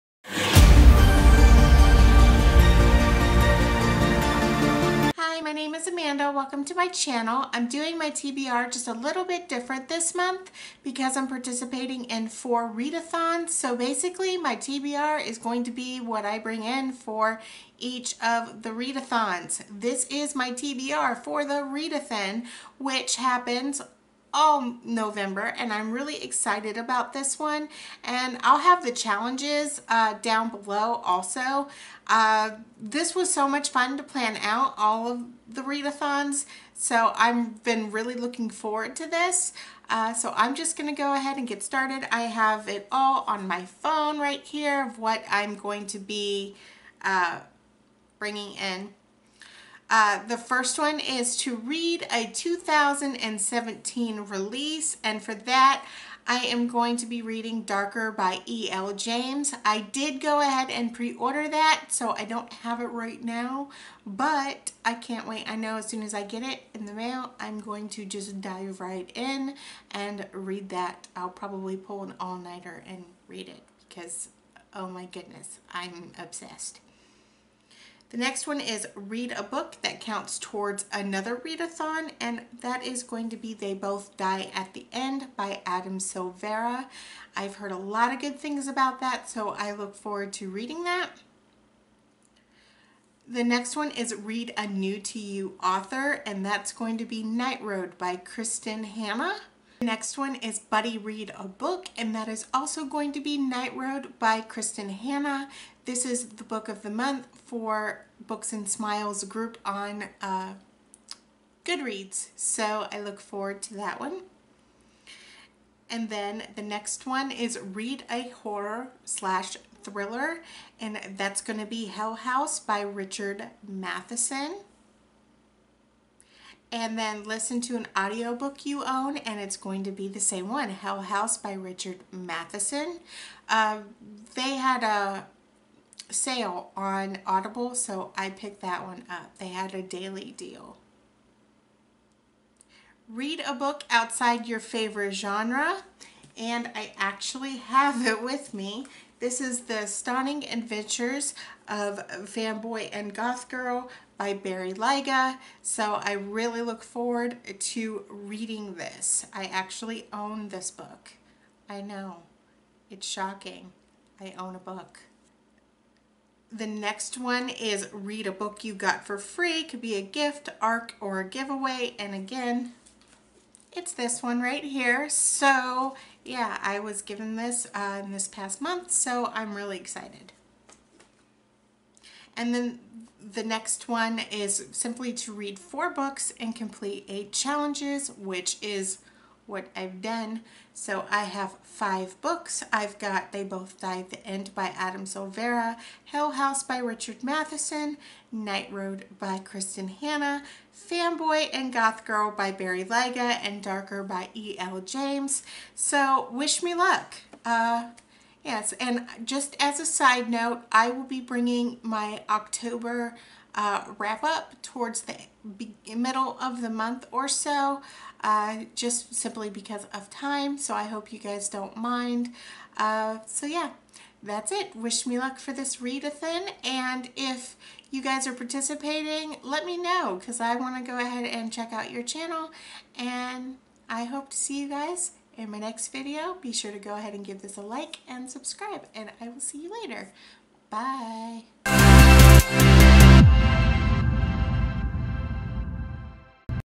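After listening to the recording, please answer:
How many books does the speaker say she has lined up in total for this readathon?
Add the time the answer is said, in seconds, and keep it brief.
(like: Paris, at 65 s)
5, at 191 s.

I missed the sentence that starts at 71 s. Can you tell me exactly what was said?
I'll probably pull an all-nighter and read it because, oh my goodness, I'm obsessed.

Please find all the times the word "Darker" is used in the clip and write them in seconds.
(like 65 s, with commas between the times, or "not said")
57 s, 203 s.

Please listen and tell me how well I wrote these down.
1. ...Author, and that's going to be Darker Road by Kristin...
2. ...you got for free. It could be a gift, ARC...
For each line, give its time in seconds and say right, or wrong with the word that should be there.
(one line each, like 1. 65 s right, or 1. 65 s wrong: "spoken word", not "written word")
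1. 95 s wrong: "Night", not "Darker"
2. 168 s right.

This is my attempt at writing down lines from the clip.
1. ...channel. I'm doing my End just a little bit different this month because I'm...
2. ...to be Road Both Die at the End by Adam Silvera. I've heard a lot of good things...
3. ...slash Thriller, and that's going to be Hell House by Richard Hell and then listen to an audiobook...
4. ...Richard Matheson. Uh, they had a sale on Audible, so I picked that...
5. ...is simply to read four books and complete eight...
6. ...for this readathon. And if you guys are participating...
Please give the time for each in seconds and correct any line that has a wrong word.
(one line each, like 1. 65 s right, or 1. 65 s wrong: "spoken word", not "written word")
1. 6 s wrong: "TBR", not "End"
2. 83 s wrong: "They", not "Road"
3. 119 s wrong: "Matheson", not "Hell"
4. 131 s right
5. 184 s right
6. 225 s right.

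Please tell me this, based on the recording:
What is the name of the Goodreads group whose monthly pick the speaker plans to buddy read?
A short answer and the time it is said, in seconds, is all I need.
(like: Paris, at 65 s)
Books and Smiles, at 108 s.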